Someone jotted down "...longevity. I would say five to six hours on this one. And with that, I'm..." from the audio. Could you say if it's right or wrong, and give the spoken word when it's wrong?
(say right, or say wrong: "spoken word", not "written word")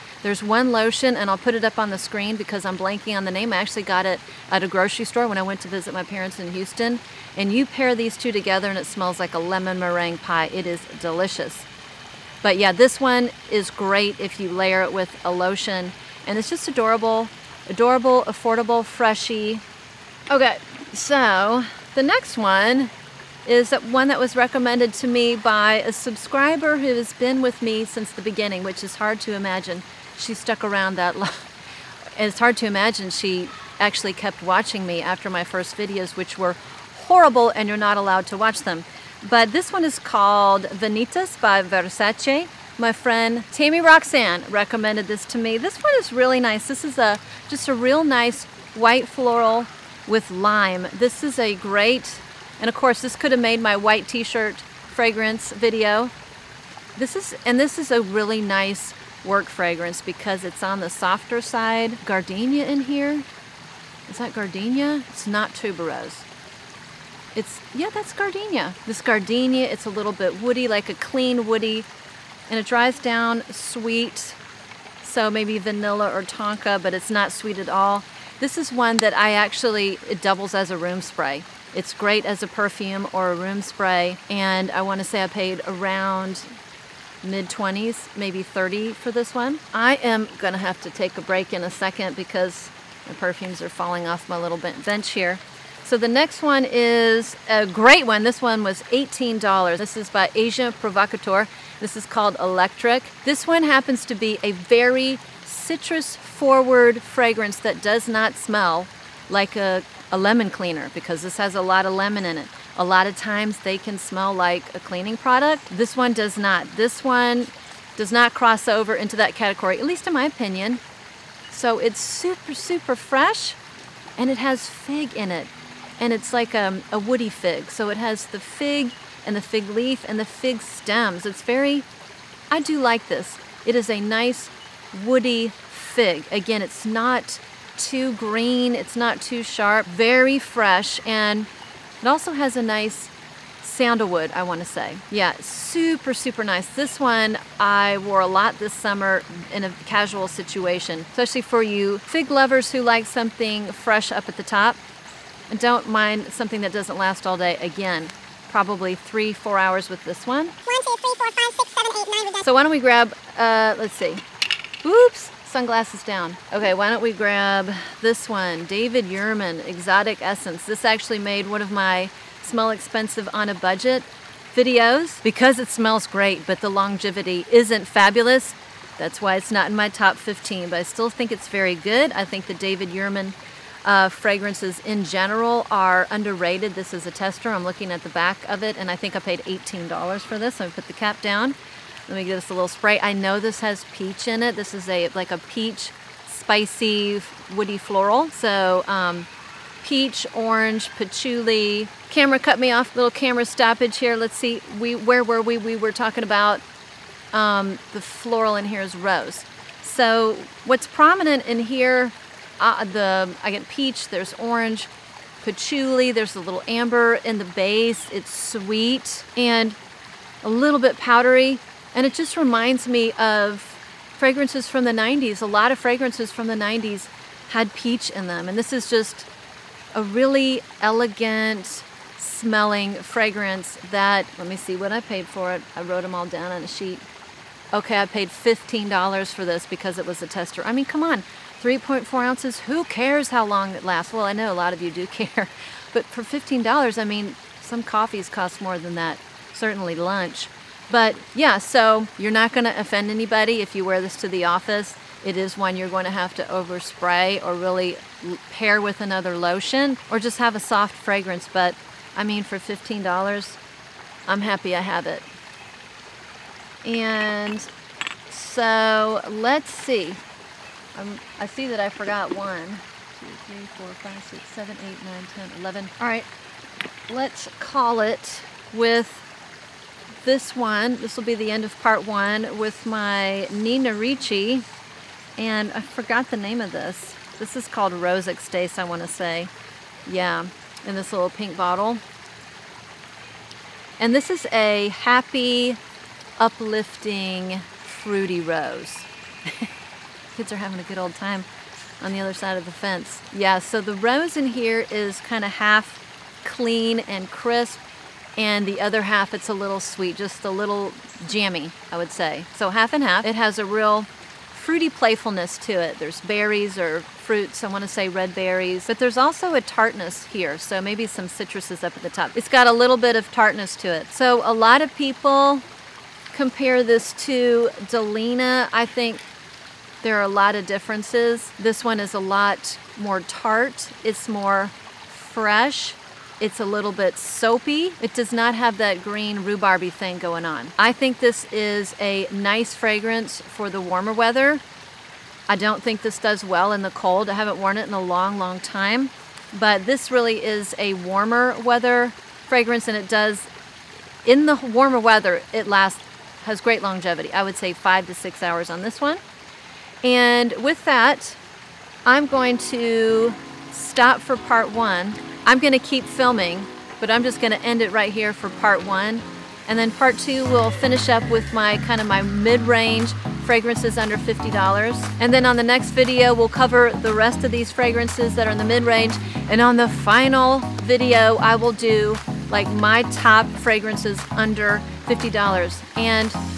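right.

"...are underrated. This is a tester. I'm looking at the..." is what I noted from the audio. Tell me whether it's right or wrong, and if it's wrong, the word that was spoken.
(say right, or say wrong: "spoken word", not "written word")
right.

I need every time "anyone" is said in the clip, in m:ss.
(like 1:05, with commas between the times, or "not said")
not said.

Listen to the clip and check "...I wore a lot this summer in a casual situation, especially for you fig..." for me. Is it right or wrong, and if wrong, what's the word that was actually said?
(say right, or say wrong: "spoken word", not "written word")
right.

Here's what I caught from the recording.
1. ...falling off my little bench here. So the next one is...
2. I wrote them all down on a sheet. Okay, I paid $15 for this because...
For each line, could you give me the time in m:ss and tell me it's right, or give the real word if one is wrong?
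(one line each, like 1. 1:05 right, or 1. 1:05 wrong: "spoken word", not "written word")
1. 1:33 right
2. 3:55 right.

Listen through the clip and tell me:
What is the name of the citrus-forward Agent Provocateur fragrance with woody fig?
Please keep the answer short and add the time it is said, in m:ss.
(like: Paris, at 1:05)
Electric, at 1:42.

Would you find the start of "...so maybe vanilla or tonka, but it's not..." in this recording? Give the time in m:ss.
1:15.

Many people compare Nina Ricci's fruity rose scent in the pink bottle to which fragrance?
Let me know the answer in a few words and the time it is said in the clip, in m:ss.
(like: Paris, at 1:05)
Delina, at 5:27.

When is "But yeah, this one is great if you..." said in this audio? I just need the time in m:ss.
0:12.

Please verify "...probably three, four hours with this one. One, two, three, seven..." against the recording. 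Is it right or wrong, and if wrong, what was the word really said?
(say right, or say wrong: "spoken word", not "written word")
wrong: "four", not "seven".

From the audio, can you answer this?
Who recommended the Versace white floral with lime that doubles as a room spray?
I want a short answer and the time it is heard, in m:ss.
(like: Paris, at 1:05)
Tammy Roxanne, at 0:43.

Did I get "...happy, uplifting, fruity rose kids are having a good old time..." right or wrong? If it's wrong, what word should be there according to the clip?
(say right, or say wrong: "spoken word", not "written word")
right.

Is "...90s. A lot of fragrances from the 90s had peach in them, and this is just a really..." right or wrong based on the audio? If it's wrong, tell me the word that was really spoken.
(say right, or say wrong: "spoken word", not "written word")
right.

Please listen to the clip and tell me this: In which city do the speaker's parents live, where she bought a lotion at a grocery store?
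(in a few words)
Houston.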